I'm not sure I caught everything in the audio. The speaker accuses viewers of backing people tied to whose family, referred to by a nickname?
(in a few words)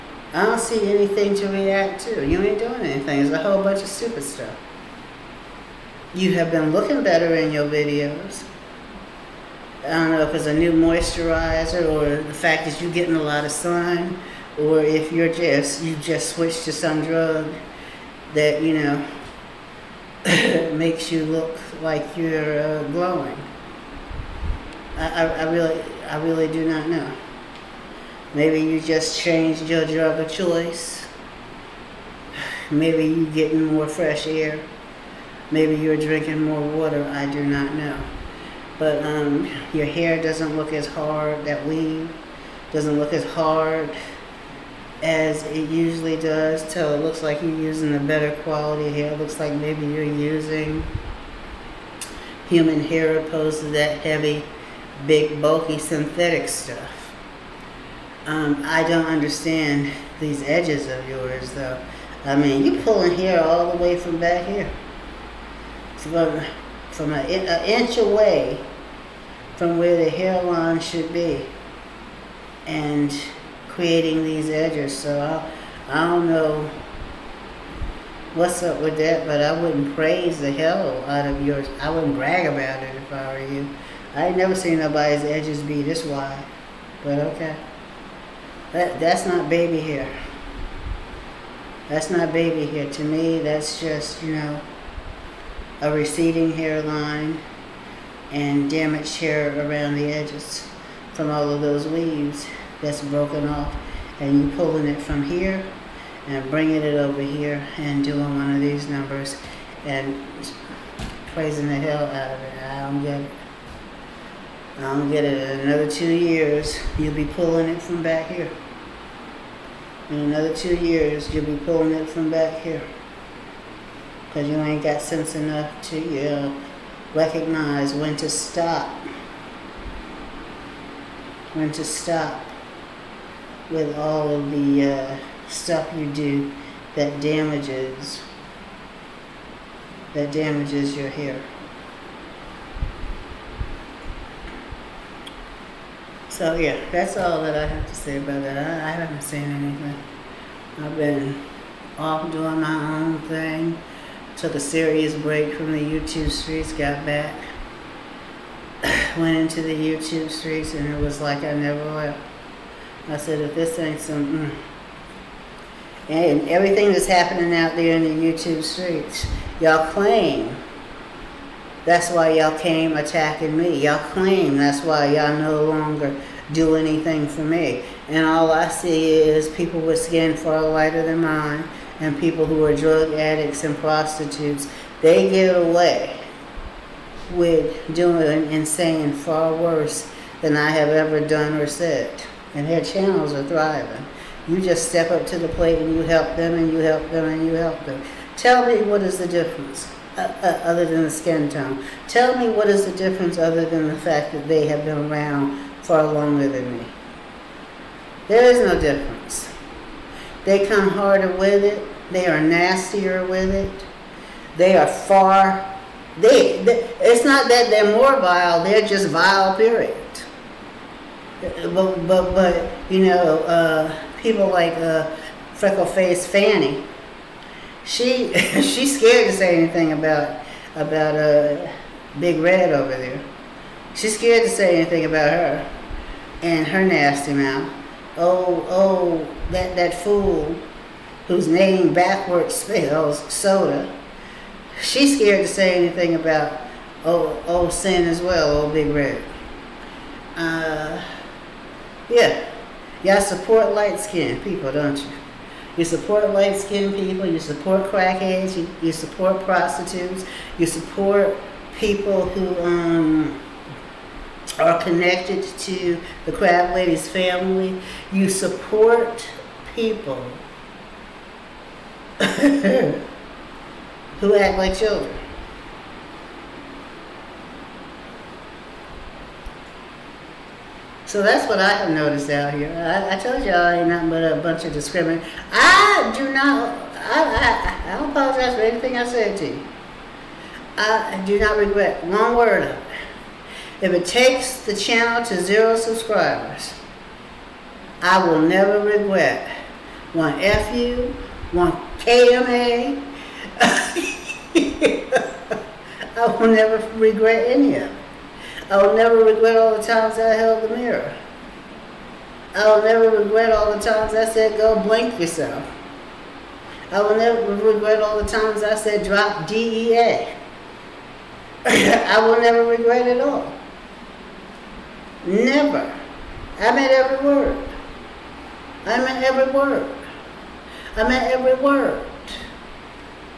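The crab lady's.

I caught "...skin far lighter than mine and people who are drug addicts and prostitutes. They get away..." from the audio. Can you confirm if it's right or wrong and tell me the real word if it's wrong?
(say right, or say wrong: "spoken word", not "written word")
right.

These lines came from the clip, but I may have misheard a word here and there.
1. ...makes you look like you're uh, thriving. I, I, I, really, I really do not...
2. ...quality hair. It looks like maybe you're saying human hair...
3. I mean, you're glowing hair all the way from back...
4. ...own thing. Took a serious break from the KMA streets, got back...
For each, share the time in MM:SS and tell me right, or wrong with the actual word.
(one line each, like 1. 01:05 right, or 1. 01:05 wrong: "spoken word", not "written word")
1. 00:20 wrong: "glowing", not "thriving"
2. 00:48 wrong: "using", not "saying"
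3. 01:02 wrong: "pulling", not "glowing"
4. 02:32 wrong: "YouTube", not "KMA".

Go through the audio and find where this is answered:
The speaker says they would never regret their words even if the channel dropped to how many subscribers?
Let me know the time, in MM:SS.
04:55.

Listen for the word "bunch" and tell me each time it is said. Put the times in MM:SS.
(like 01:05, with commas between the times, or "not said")
00:03, 04:44.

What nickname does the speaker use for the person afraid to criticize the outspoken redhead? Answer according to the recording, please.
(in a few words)
Freckle faced Fanny.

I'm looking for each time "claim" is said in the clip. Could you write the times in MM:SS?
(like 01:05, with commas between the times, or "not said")
02:49, 02:54.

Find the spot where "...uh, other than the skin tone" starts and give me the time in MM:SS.
03:20.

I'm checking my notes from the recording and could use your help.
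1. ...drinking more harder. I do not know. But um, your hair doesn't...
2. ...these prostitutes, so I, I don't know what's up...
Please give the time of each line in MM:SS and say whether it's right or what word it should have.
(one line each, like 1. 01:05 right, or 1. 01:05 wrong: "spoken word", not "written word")
1. 00:35 wrong: "water", not "harder"
2. 01:14 wrong: "edges", not "prostitutes".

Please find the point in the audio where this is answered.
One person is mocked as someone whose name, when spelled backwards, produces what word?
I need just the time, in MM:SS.
04:03.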